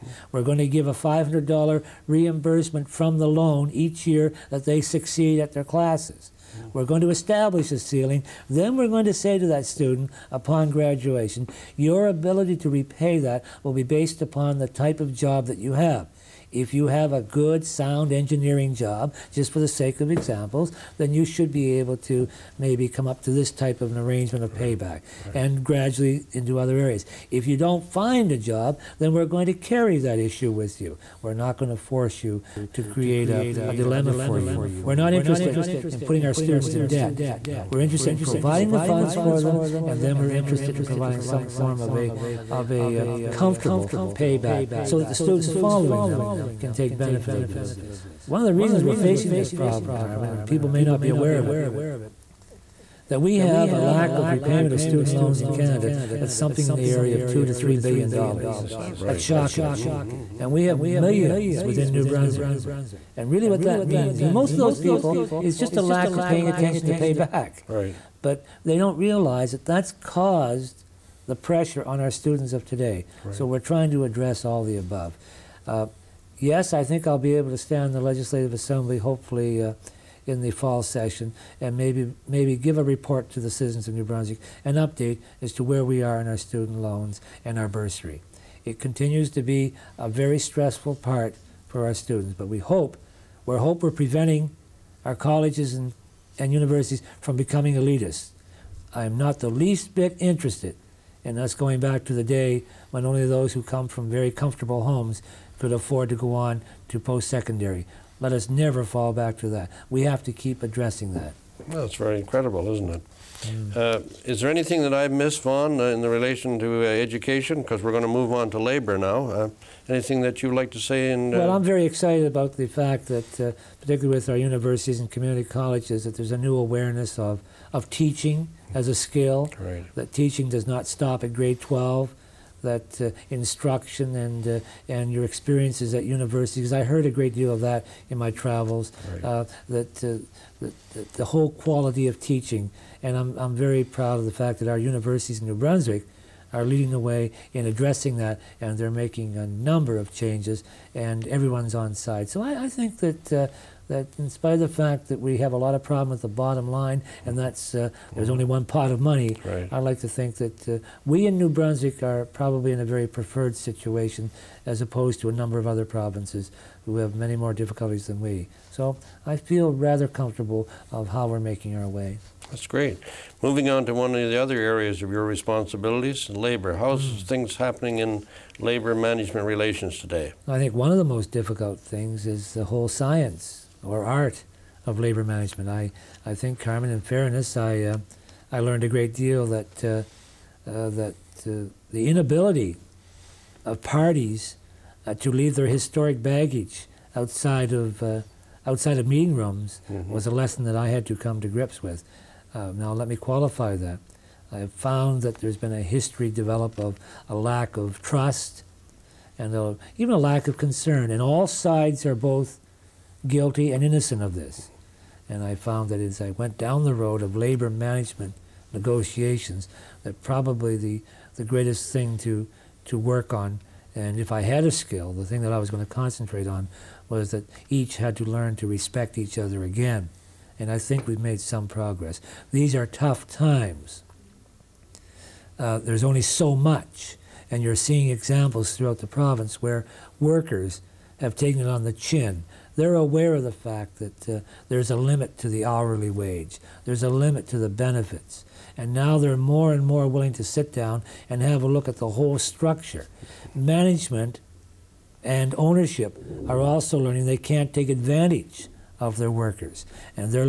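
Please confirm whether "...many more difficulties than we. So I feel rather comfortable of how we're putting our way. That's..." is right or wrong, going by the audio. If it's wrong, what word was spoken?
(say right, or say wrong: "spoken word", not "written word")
wrong: "making", not "putting".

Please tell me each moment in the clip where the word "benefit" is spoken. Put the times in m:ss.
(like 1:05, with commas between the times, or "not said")
0:46, 4:07.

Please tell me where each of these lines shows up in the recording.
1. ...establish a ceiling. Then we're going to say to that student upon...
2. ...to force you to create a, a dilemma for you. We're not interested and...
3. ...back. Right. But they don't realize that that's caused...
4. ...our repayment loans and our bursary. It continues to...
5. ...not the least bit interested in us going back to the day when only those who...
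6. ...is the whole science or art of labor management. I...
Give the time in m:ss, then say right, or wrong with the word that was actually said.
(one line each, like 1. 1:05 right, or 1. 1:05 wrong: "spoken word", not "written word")
1. 0:07 right
2. 0:31 right
3. 1:07 right
4. 1:26 wrong: "student", not "repayment"
5. 1:39 right
6. 3:02 right.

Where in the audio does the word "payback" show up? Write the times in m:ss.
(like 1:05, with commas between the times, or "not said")
0:24, 0:44.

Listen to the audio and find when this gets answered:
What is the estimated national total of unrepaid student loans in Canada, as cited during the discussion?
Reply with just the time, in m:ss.
0:57.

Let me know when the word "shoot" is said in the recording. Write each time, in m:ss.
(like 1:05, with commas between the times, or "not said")
not said.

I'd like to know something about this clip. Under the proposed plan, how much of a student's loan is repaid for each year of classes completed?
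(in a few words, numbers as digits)
$500.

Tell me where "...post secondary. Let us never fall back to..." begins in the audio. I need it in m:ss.
1:46.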